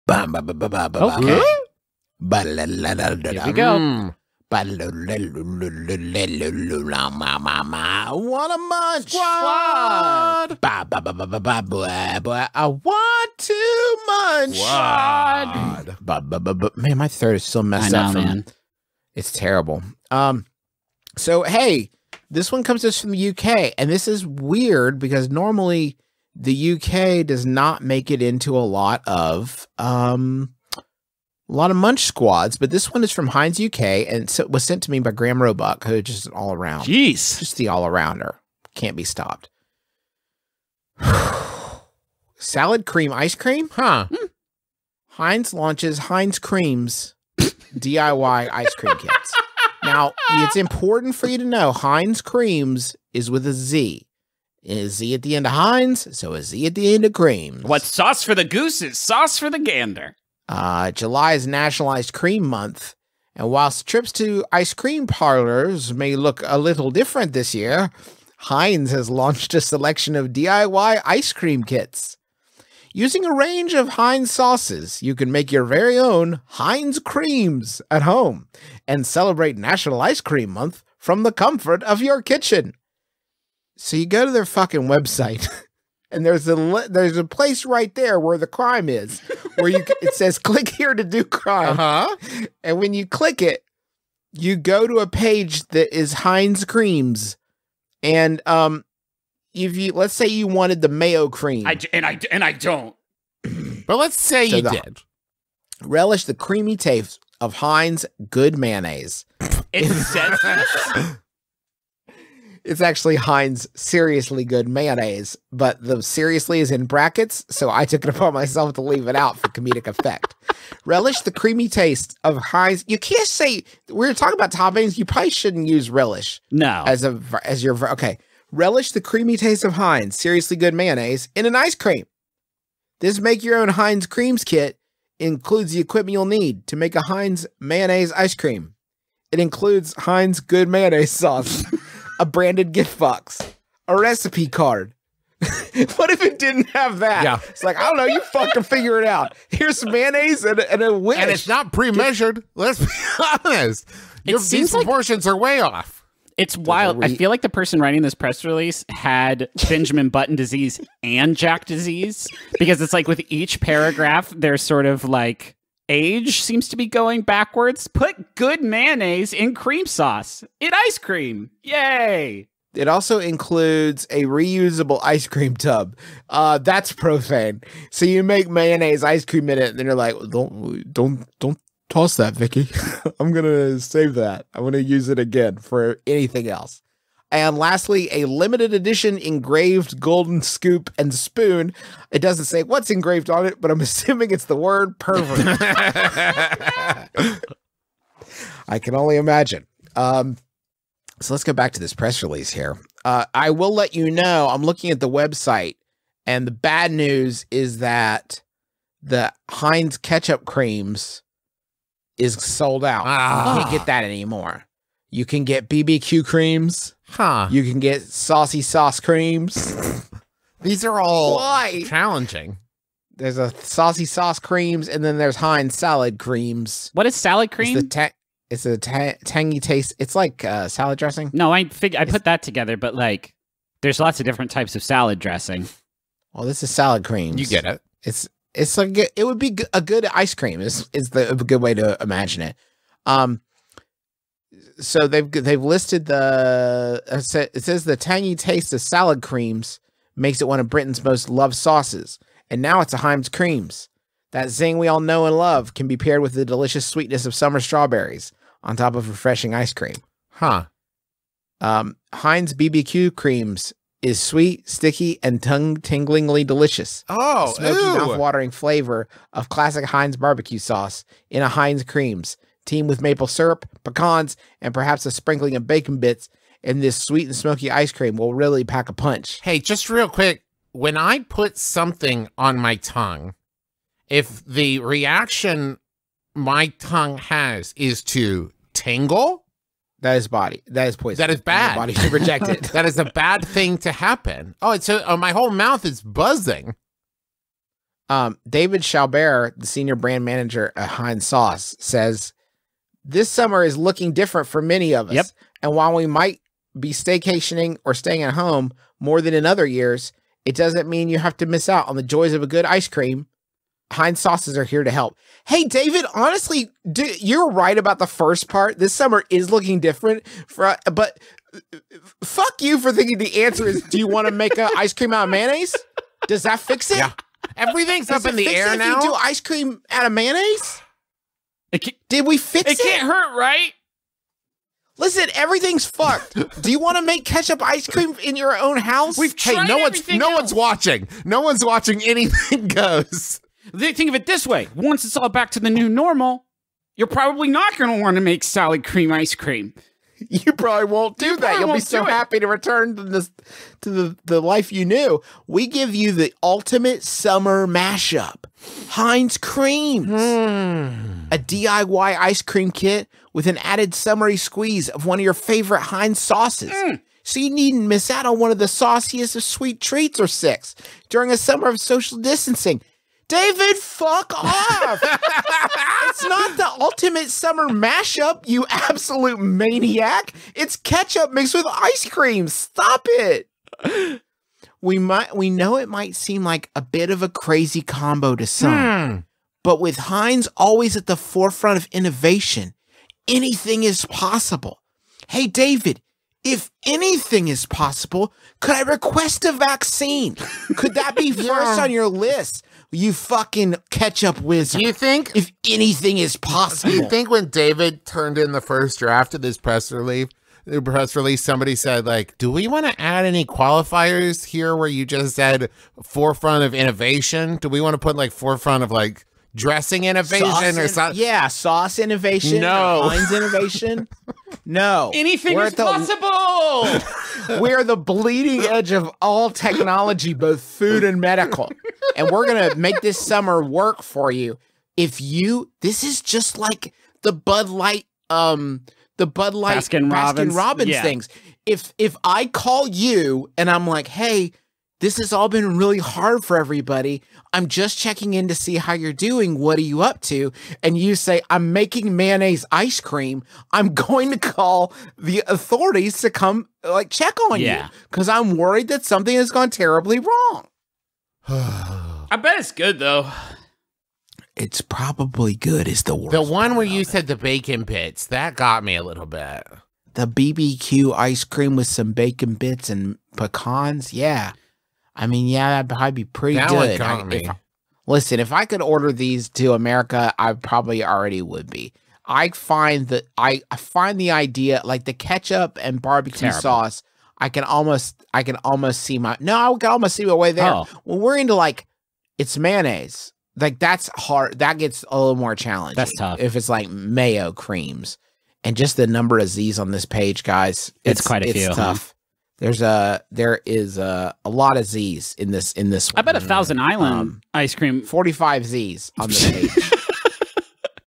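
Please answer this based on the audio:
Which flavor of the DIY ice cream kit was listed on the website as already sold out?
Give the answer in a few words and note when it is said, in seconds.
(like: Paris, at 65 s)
Ketchup creams, at 209 s.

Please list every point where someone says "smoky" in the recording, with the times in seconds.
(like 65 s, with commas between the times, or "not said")
267 s, 277 s.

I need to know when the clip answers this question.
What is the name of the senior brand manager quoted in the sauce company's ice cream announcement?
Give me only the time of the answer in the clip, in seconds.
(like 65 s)
298 s.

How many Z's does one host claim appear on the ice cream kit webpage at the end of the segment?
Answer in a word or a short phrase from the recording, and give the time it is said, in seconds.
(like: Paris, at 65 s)
45, at 508 s.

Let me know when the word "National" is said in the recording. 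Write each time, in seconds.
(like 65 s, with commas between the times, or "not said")
61 s, 79 s.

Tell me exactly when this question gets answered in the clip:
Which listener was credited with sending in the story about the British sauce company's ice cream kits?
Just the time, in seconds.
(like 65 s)
35 s.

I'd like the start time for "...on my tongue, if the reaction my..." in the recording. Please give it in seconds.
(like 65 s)
282 s.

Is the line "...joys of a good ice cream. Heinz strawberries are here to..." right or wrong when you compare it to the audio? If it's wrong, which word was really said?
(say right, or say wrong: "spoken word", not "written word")
wrong: "sauces", not "strawberries".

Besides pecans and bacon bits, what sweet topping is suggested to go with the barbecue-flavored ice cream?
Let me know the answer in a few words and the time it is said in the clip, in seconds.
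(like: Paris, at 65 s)
Maple syrup, at 273 s.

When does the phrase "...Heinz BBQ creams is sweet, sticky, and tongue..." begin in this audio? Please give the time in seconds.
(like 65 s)
262 s.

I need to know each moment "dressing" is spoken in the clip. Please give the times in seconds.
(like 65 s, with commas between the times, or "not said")
230 s, 235 s, 419 s.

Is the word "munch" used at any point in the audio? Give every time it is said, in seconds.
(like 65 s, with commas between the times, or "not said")
8 s, 14 s, 31 s.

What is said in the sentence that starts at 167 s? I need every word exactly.
Put good mayonnaise in cream sauce.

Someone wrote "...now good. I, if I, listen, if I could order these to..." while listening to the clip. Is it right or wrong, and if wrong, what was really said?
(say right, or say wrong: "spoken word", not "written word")
right.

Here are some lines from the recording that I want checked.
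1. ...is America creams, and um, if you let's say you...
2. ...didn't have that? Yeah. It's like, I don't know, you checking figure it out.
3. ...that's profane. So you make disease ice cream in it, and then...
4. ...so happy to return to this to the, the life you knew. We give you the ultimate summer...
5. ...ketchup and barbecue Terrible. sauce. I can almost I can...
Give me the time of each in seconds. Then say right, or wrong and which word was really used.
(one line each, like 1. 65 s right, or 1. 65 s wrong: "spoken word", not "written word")
1. 95 s wrong: "Heinz", not "America"
2. 146 s wrong: "fucking", not "checking"
3. 176 s wrong: "mayonnaise", not "disease"
4. 351 s right
5. 485 s right.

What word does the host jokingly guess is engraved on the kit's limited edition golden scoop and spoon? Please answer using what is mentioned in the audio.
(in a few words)
Pervert.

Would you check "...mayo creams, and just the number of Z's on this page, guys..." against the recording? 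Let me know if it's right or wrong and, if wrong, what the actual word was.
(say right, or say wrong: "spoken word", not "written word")
right.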